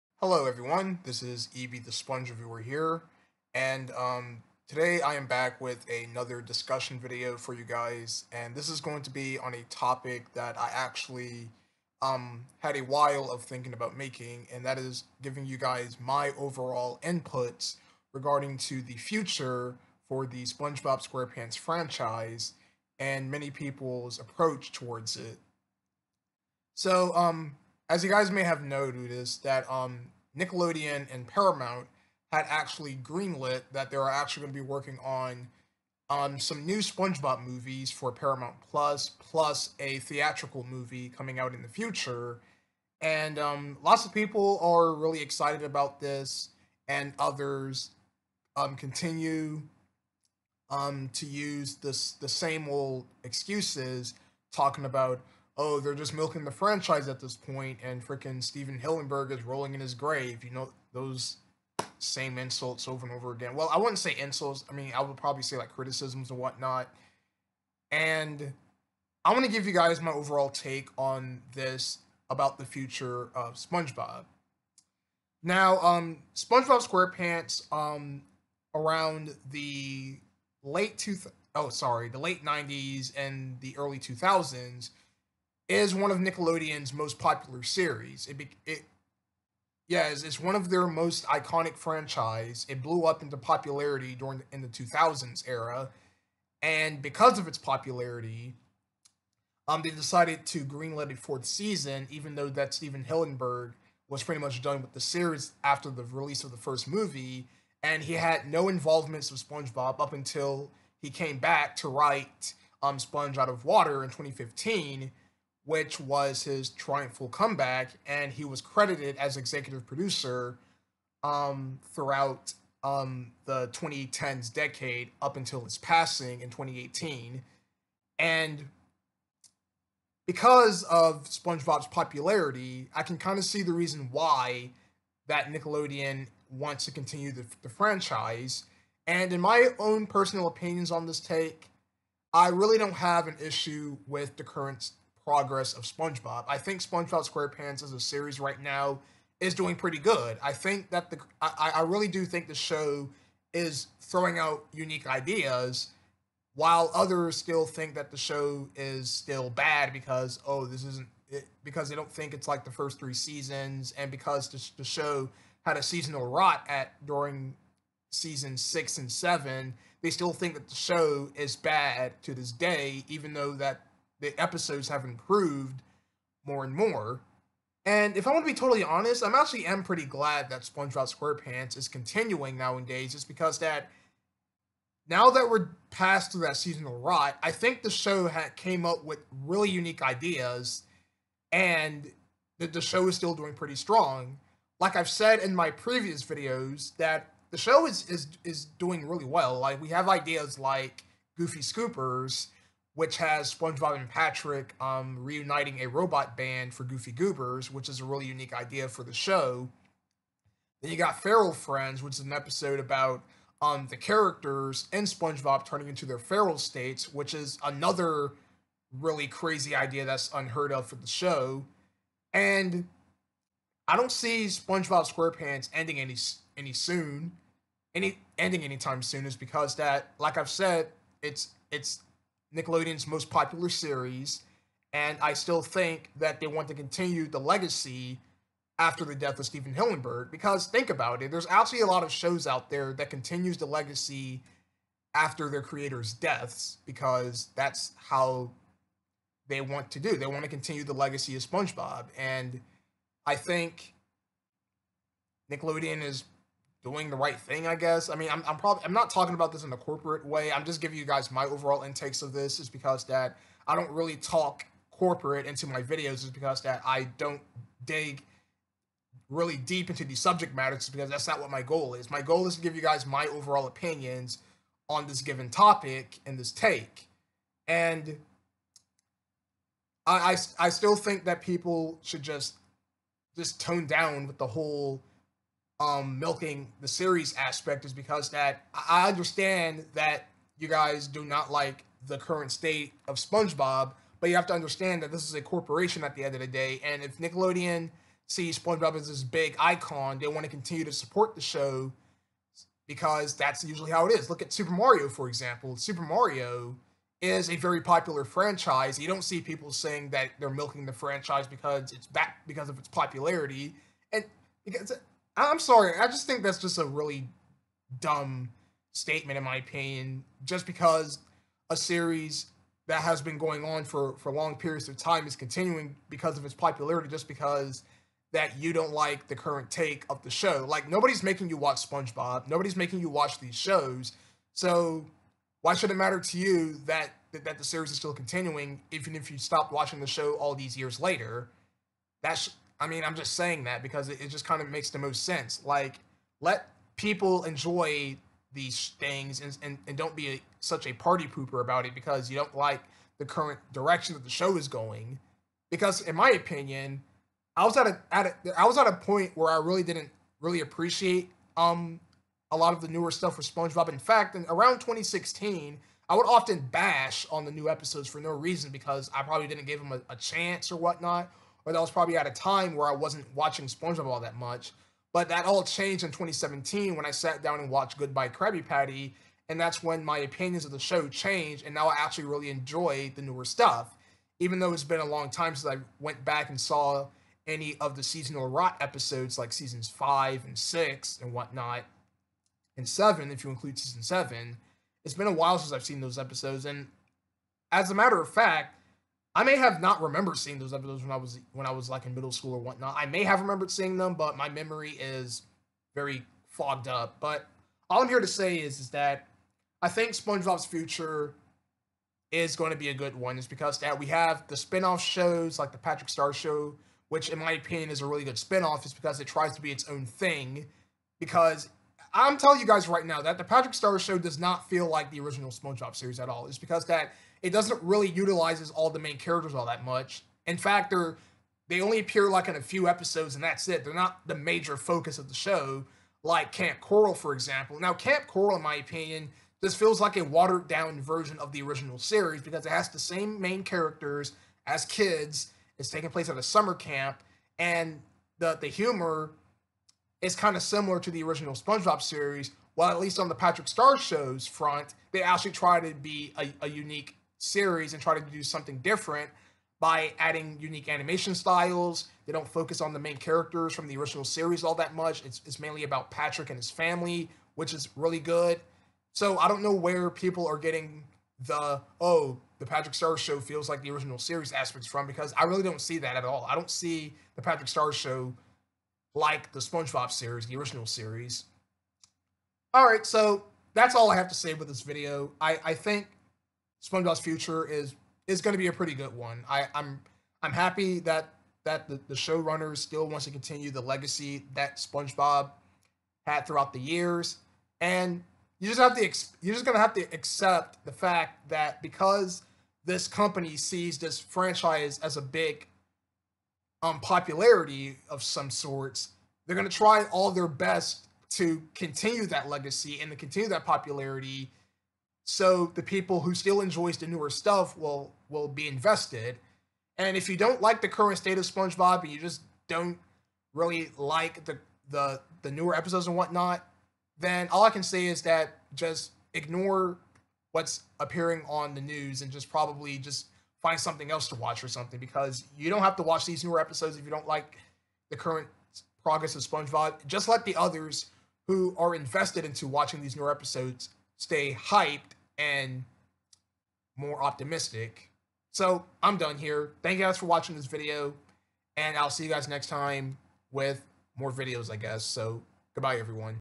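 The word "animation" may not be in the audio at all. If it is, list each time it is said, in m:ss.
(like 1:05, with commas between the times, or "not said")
7:40.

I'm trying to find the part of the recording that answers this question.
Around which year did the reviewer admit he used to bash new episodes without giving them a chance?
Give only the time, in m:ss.
6:04.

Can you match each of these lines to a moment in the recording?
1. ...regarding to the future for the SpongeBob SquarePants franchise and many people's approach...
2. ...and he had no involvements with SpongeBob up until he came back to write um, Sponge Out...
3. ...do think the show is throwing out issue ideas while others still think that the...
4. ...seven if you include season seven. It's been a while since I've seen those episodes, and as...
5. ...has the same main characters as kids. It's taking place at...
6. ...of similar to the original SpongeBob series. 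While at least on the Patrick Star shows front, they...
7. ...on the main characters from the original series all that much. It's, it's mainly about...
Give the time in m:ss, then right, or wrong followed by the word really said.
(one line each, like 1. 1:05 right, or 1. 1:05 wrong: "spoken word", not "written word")
1. 0:18 right
2. 1:47 right
3. 2:32 wrong: "unique", not "issue"
4. 6:32 right
5. 7:22 right
6. 7:30 right
7. 7:42 right.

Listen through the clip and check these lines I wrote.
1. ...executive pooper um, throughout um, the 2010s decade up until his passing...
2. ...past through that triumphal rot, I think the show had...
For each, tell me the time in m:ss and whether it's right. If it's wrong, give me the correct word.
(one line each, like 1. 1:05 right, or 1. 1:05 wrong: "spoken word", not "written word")
1. 1:59 wrong: "producer", not "pooper"
2. 3:05 wrong: "seasonal", not "triumphal".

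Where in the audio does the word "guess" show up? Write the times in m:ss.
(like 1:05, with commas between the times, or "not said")
4:17, 9:14.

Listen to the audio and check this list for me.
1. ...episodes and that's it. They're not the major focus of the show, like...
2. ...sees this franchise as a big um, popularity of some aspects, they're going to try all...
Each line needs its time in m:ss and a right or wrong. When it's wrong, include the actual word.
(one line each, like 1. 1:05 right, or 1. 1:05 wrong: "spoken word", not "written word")
1. 7:12 right
2. 8:23 wrong: "sorts", not "aspects".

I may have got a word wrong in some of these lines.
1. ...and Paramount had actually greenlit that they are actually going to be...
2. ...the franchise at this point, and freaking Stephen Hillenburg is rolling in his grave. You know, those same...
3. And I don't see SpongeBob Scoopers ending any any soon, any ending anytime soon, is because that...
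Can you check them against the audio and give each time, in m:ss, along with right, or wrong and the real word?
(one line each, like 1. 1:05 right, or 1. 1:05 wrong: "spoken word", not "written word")
1. 0:31 right
2. 0:56 right
3. 3:42 wrong: "SquarePants", not "Scoopers".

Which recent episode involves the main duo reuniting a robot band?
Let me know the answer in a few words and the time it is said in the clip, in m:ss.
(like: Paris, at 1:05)
Goofy Scoopers, at 3:21.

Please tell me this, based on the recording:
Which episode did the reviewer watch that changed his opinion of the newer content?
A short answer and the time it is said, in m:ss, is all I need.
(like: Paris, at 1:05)
Goodbye Krabby Patty, at 6:17.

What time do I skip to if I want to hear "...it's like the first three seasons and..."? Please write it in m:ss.
2:42.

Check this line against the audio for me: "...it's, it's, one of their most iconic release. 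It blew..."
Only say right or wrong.
wrong.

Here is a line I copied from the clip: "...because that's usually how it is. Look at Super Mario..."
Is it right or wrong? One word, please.
right.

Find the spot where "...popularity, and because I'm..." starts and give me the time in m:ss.
5:12.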